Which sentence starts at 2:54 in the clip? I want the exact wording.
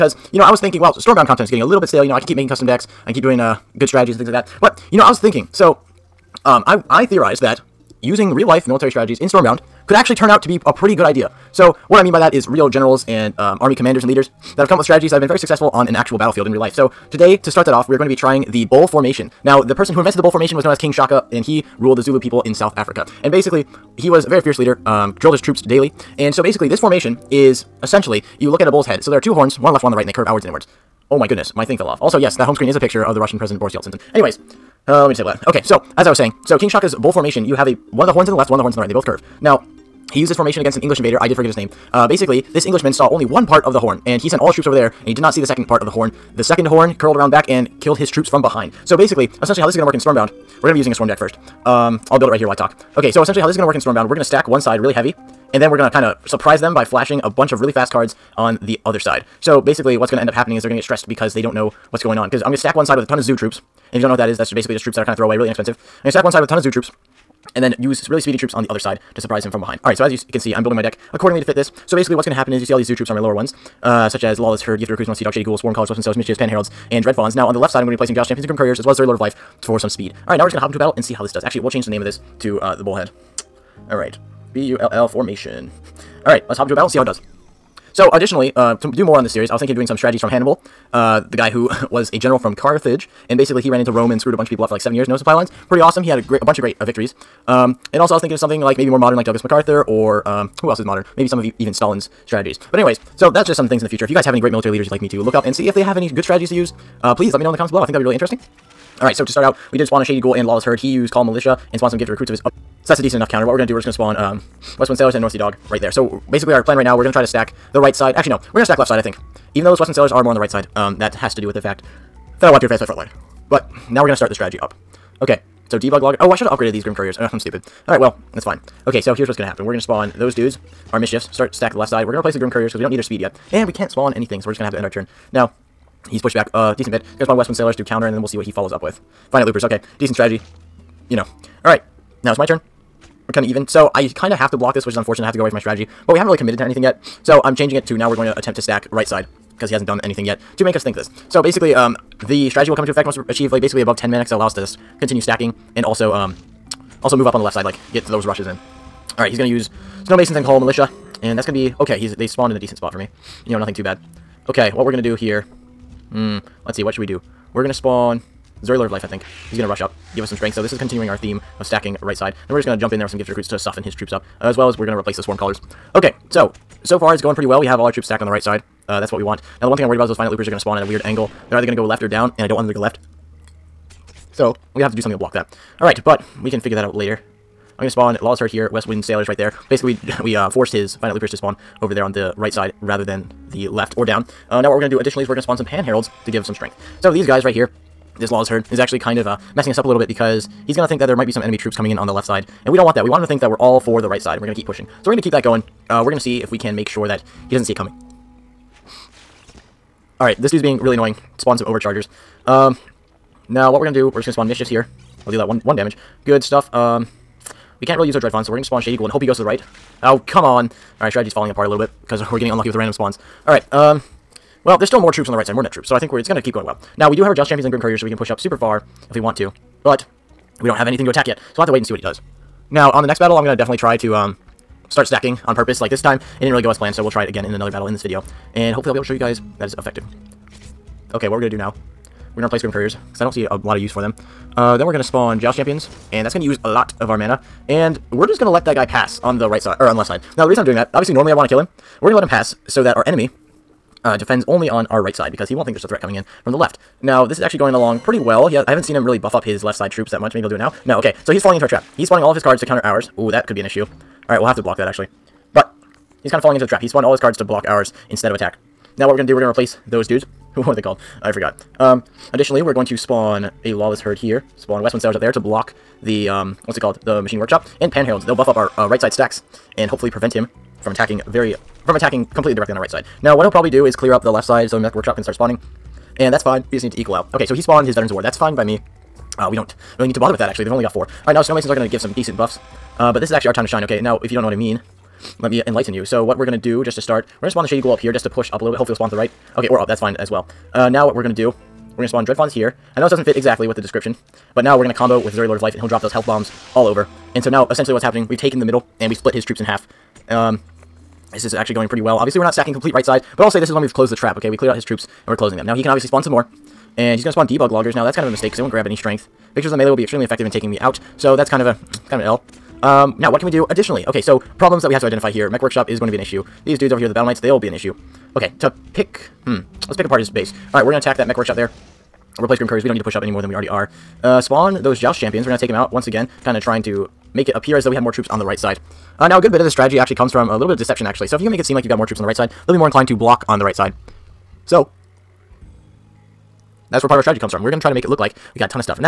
Uh, as well as we're going to replace the swarm callers.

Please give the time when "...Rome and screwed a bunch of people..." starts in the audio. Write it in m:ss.
1:33.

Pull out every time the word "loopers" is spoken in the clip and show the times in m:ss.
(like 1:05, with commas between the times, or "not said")
2:19, 3:00, 3:11.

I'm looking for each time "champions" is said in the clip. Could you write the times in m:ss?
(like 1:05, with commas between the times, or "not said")
1:18, 3:47, 4:05, 5:35.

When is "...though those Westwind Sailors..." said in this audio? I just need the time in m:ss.
1:59.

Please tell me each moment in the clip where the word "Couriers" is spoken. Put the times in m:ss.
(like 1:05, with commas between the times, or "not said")
1:18, 2:06, 2:12, 3:47, 4:02, 5:32.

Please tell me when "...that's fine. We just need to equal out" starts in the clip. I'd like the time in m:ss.
4:46.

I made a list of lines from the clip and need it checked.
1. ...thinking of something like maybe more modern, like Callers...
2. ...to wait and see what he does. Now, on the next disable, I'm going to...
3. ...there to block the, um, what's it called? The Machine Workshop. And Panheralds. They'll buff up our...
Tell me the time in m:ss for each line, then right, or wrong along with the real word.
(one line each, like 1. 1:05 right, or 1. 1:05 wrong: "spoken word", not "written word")
1. 1:38 wrong: "Douglas", not "Callers"
2. 3:51 wrong: "battle", not "disable"
3. 4:35 right.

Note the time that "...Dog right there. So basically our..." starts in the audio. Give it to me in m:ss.
1:55.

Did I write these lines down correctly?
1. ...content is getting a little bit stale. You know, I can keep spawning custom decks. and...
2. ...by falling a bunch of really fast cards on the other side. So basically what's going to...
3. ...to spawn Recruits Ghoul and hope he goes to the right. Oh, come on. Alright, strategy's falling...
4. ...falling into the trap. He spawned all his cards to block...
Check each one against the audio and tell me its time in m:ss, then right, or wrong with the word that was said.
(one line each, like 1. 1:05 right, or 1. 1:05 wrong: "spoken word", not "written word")
1. 0:01 wrong: "making", not "spawning"
2. 0:56 wrong: "flashing", not "falling"
3. 3:38 wrong: "Shady", not "Recruits"
4. 4:26 right.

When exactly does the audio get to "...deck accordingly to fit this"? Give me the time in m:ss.
1:10.